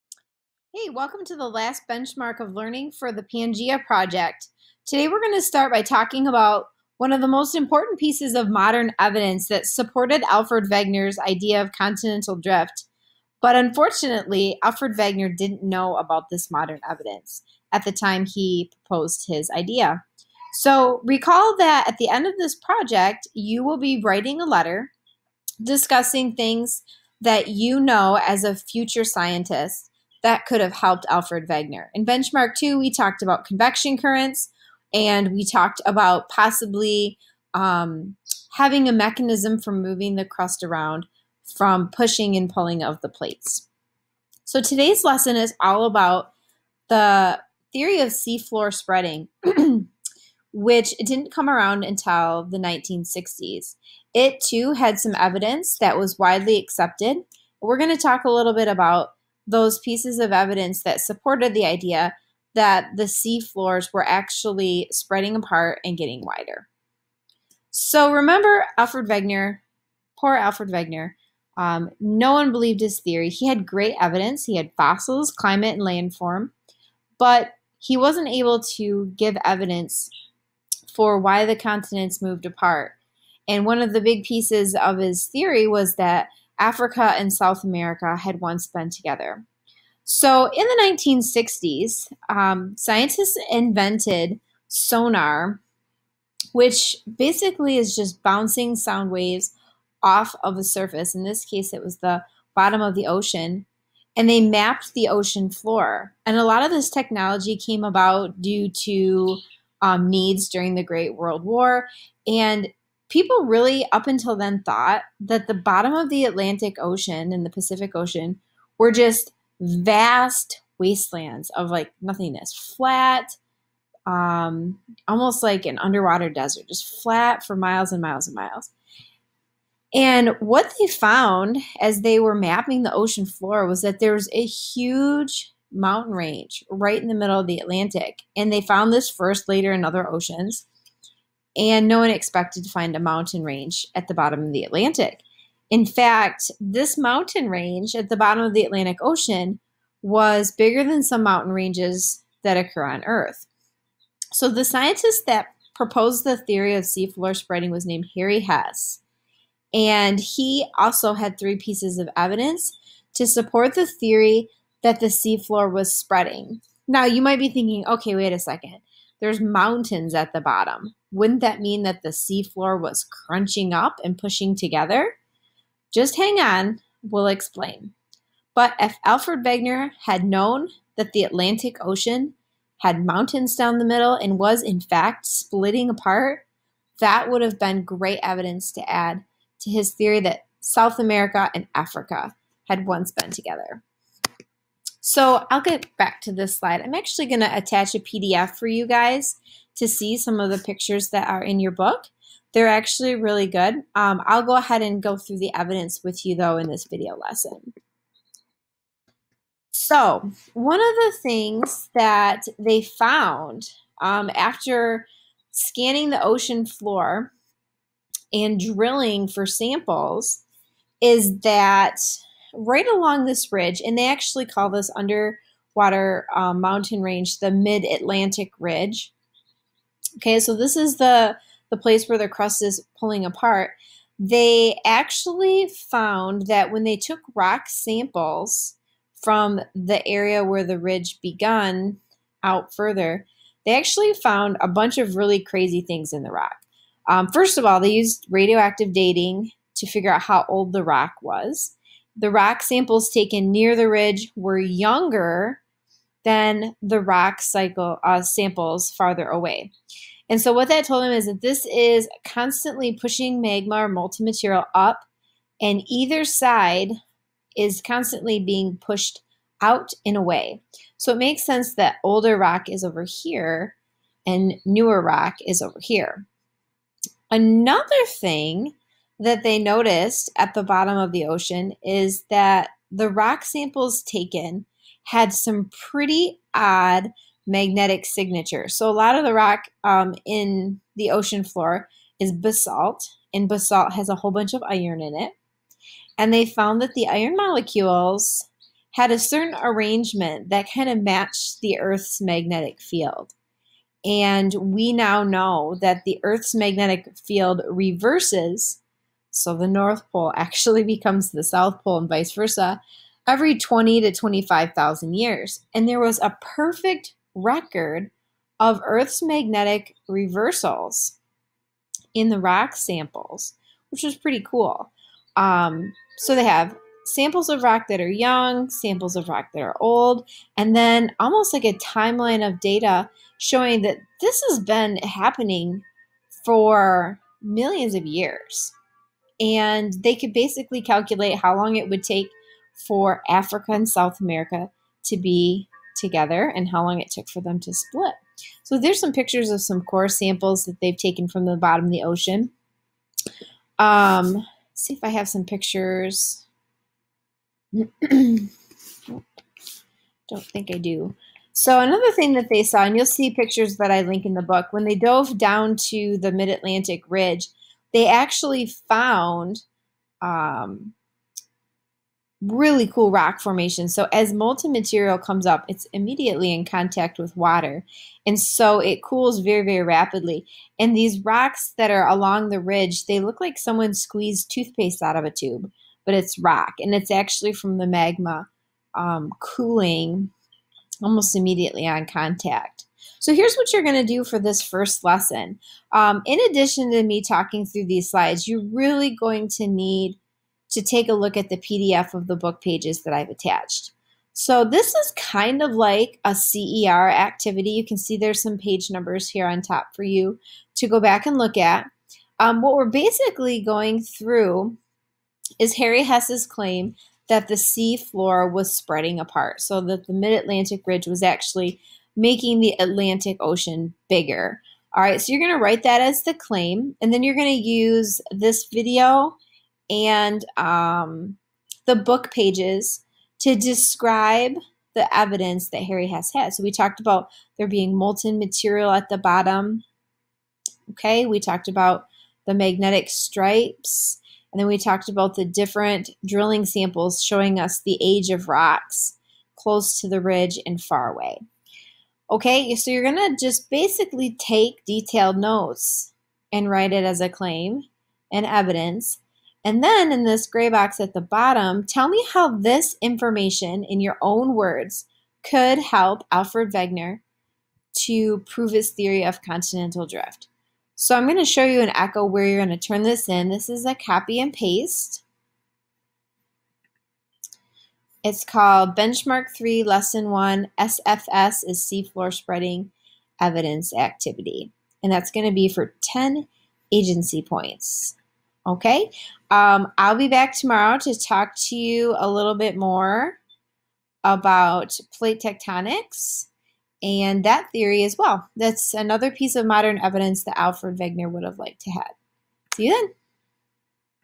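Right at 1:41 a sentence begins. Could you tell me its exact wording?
In this case, it was the bottom of the ocean.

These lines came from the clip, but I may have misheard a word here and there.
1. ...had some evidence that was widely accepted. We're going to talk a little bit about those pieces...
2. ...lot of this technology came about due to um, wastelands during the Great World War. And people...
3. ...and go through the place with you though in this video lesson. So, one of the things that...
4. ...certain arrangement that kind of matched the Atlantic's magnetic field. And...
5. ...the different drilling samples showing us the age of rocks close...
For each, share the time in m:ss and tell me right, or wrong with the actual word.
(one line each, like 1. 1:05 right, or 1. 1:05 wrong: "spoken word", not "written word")
1. 0:54 right
2. 1:46 wrong: "needs", not "wastelands"
3. 3:24 wrong: "evidence", not "place"
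4. 4:59 wrong: "Earth", not "Atlantic"
5. 7:25 right.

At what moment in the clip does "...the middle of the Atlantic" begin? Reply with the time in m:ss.
2:17.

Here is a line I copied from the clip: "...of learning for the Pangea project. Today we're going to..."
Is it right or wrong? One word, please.
right.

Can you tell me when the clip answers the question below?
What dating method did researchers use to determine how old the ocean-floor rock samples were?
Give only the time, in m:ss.
4:08.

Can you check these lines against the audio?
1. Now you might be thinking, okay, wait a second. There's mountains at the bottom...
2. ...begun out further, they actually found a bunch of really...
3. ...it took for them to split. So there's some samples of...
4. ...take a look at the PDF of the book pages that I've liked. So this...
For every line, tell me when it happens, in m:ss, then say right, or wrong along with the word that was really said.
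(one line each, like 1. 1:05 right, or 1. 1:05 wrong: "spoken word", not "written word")
1. 2:46 right
2. 4:01 right
3. 5:46 wrong: "pictures", not "samples"
4. 6:40 wrong: "attached", not "liked".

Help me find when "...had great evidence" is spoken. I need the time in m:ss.
1:13.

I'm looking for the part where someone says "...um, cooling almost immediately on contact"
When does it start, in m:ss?
6:28.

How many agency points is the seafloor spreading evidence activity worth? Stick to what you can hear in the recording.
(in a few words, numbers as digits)
10.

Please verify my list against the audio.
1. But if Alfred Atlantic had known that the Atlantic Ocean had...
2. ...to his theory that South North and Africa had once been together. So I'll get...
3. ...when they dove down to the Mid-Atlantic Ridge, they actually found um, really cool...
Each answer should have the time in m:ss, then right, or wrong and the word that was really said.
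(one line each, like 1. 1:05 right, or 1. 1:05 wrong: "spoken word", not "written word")
1. 2:58 wrong: "Wegener", not "Atlantic"
2. 3:09 wrong: "America", not "North"
3. 6:04 right.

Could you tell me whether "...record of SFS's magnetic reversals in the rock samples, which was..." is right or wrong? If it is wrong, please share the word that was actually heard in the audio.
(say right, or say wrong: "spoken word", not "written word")
wrong: "Earth", not "SFS".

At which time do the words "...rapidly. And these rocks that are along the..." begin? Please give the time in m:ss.
6:19.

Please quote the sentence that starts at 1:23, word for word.
And one of the big pieces of his theory was that Africa and South America had once been together.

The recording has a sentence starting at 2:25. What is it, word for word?
In fact, this mountain range at the bottom of the Atlantic Ocean was bigger than some mountain ranges that occur on Earth.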